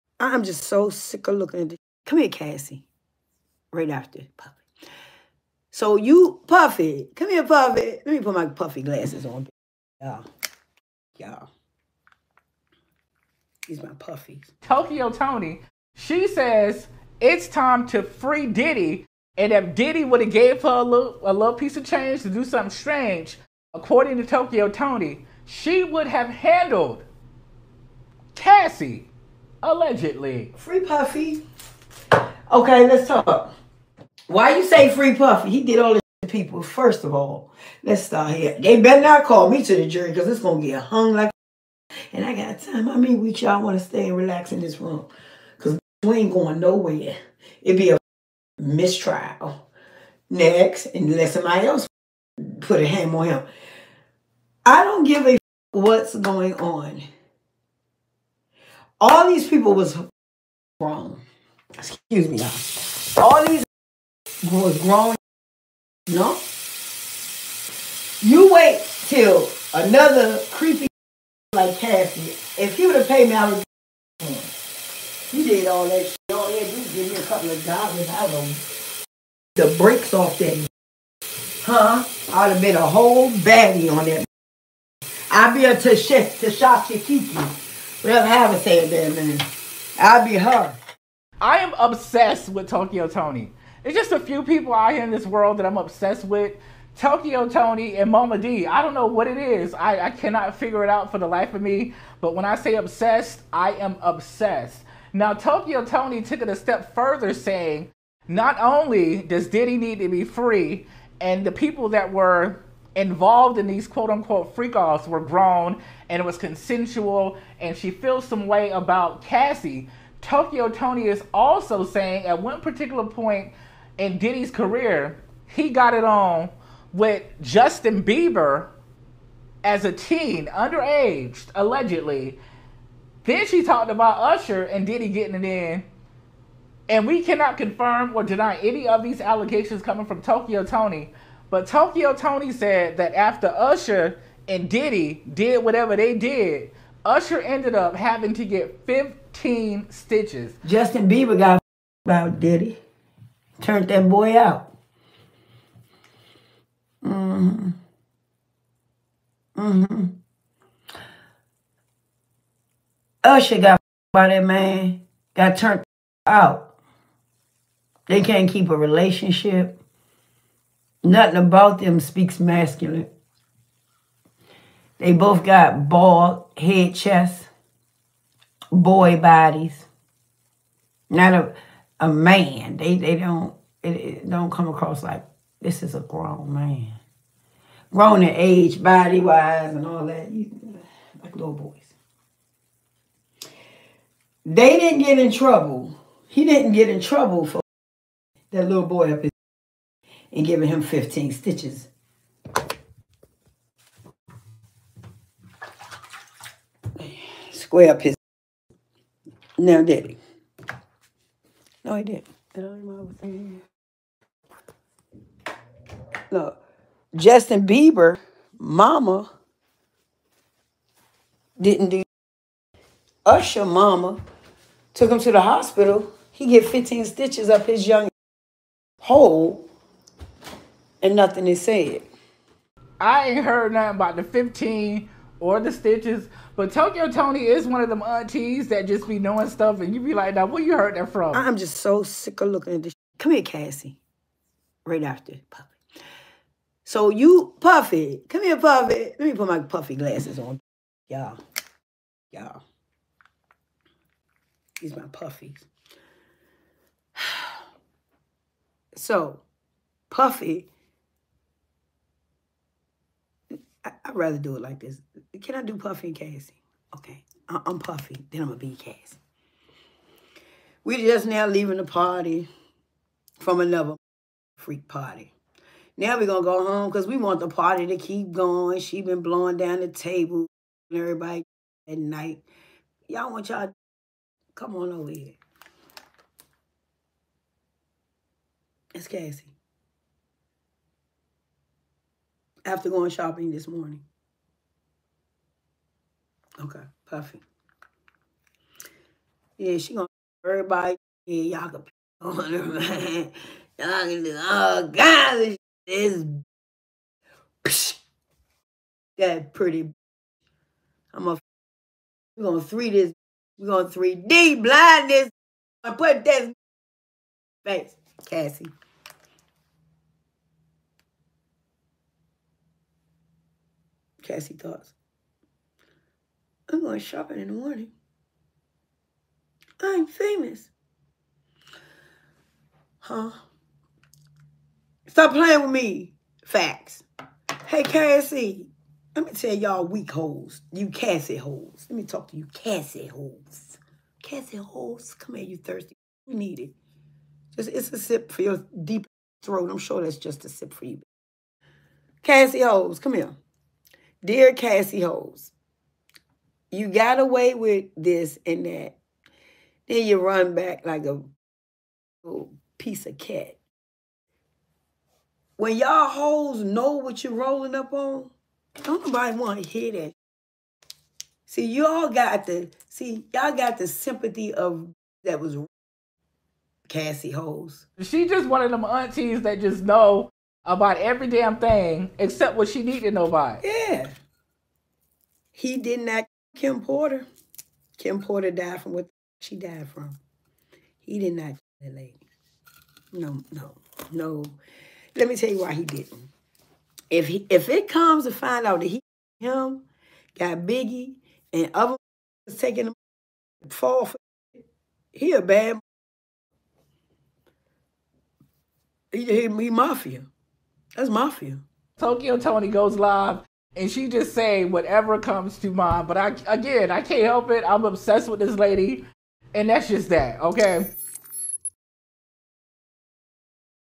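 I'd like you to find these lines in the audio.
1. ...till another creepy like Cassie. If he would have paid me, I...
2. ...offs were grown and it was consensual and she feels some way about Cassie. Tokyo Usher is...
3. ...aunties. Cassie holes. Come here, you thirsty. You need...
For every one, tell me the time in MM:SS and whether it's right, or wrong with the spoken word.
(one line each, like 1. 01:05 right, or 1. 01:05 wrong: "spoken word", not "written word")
1. 01:09 right
2. 01:54 wrong: "Toni", not "Usher"
3. 05:43 wrong: "holes", not "aunties".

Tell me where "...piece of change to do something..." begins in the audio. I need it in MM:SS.
00:21.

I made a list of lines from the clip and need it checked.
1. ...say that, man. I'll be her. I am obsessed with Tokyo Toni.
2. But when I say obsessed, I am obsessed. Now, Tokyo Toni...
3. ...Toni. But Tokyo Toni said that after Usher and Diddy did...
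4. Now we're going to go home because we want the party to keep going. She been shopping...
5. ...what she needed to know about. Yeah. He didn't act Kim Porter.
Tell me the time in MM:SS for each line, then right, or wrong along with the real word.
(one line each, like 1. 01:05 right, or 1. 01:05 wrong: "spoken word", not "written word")
1. 01:28 right
2. 01:42 right
3. 02:20 right
4. 04:35 wrong: "blowing", not "shopping"
5. 06:22 right.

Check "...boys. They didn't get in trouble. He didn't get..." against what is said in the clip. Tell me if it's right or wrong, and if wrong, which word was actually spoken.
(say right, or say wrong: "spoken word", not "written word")
right.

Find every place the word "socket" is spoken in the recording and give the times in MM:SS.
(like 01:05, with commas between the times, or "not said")
not said.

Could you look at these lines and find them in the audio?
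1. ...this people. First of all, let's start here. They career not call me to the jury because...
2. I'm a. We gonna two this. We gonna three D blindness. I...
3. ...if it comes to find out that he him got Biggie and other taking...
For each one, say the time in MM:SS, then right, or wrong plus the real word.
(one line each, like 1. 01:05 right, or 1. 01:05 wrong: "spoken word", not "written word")
1. 00:35 wrong: "better", not "career"
2. 05:11 wrong: "three", not "two"
3. 06:37 right.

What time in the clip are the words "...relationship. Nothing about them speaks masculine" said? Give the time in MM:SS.
02:48.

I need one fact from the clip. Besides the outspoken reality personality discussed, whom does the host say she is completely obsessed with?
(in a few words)
Mama D.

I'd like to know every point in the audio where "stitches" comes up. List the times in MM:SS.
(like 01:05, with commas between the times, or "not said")
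02:29, 03:21, 03:47, 03:55.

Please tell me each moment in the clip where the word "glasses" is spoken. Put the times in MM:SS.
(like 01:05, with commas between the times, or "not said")
00:08, 04:09.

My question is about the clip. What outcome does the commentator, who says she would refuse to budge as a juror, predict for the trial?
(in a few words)
Mistrial.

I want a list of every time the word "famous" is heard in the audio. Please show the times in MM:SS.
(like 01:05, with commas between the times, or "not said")
05:30.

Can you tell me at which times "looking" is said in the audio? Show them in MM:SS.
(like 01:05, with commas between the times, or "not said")
00:01, 04:02.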